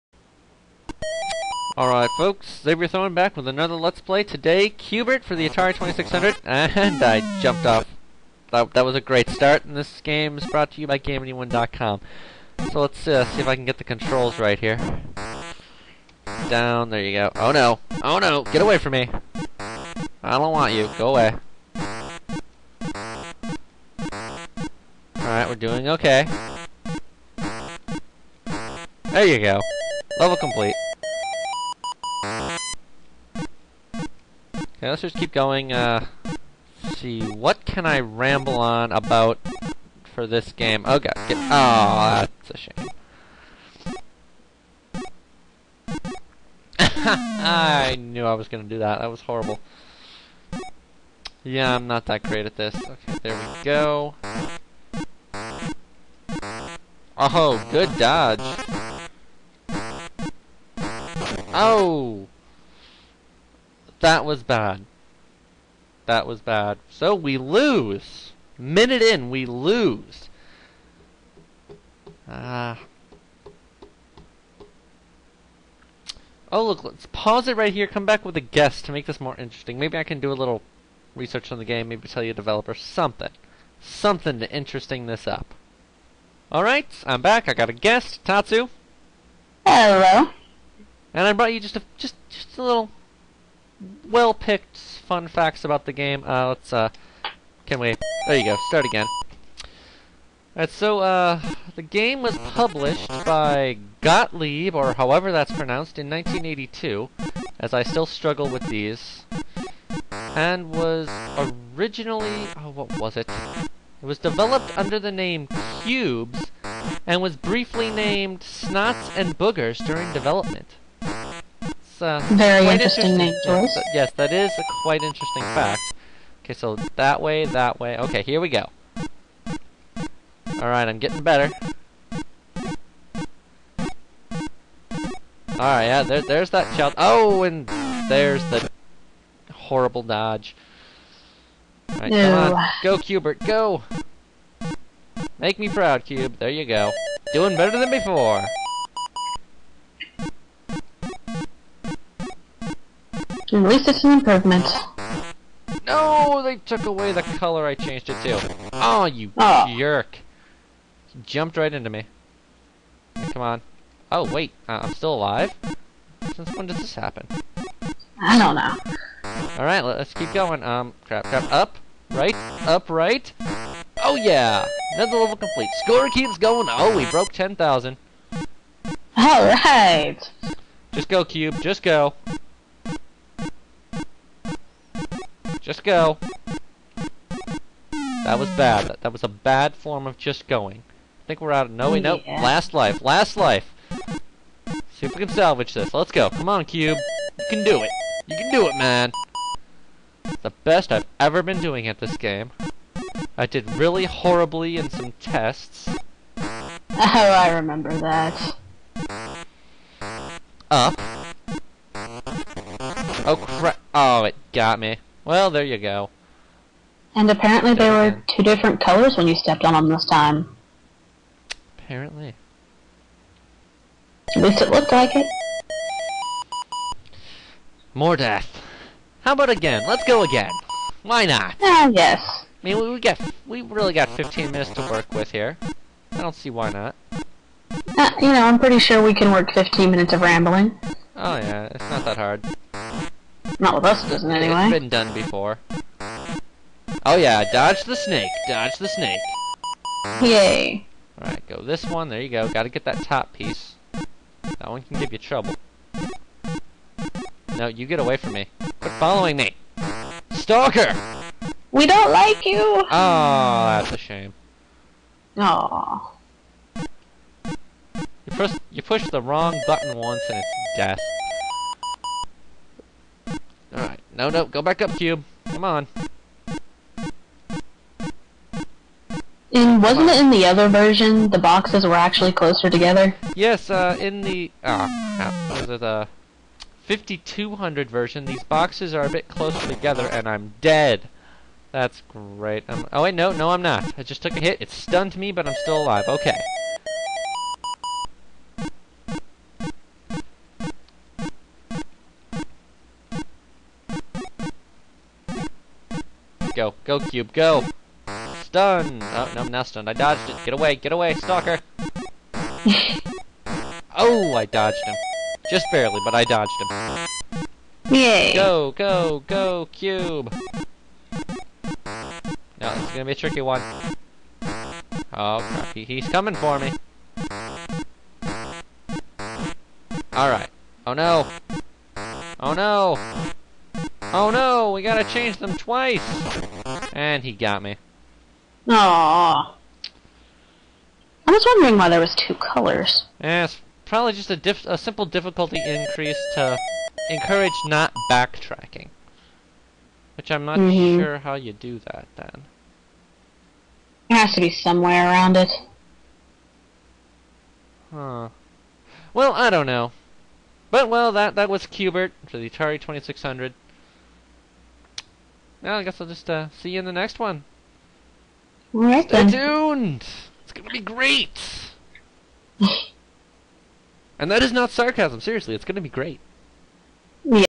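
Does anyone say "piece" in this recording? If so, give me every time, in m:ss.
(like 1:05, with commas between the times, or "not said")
4:13.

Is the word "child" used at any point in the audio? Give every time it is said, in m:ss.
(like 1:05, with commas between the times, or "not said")
2:16.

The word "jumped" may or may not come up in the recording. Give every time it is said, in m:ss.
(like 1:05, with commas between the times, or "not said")
0:07, 2:41.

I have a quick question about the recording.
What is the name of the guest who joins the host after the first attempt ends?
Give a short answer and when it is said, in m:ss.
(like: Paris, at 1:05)
Tatsu, at 1:28.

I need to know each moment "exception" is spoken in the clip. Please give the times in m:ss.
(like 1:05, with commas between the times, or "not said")
not said.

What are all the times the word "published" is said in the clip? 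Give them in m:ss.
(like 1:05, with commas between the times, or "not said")
1:42.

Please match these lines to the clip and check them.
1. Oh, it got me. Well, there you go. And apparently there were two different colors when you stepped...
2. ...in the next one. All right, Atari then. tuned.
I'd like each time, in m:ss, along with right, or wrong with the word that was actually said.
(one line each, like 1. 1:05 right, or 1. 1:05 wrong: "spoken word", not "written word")
1. 3:33 right
2. 6:06 wrong: "Stay", not "Atari".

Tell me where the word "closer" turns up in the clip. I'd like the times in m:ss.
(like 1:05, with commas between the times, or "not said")
4:42, 4:49.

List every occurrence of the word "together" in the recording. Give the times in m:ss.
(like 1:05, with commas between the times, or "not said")
4:42, 4:49.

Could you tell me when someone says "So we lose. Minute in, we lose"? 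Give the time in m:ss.
1:06.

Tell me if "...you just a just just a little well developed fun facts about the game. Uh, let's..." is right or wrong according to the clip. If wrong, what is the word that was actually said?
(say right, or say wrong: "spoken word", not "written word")
wrong: "picked", not "developed".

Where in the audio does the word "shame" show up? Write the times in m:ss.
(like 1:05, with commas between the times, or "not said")
0:42, 4:23.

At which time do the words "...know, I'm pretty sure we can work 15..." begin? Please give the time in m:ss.
3:58.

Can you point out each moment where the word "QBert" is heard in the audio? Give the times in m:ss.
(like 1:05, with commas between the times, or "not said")
0:04, 6:01.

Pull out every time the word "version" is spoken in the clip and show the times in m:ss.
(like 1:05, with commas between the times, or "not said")
4:40, 4:47.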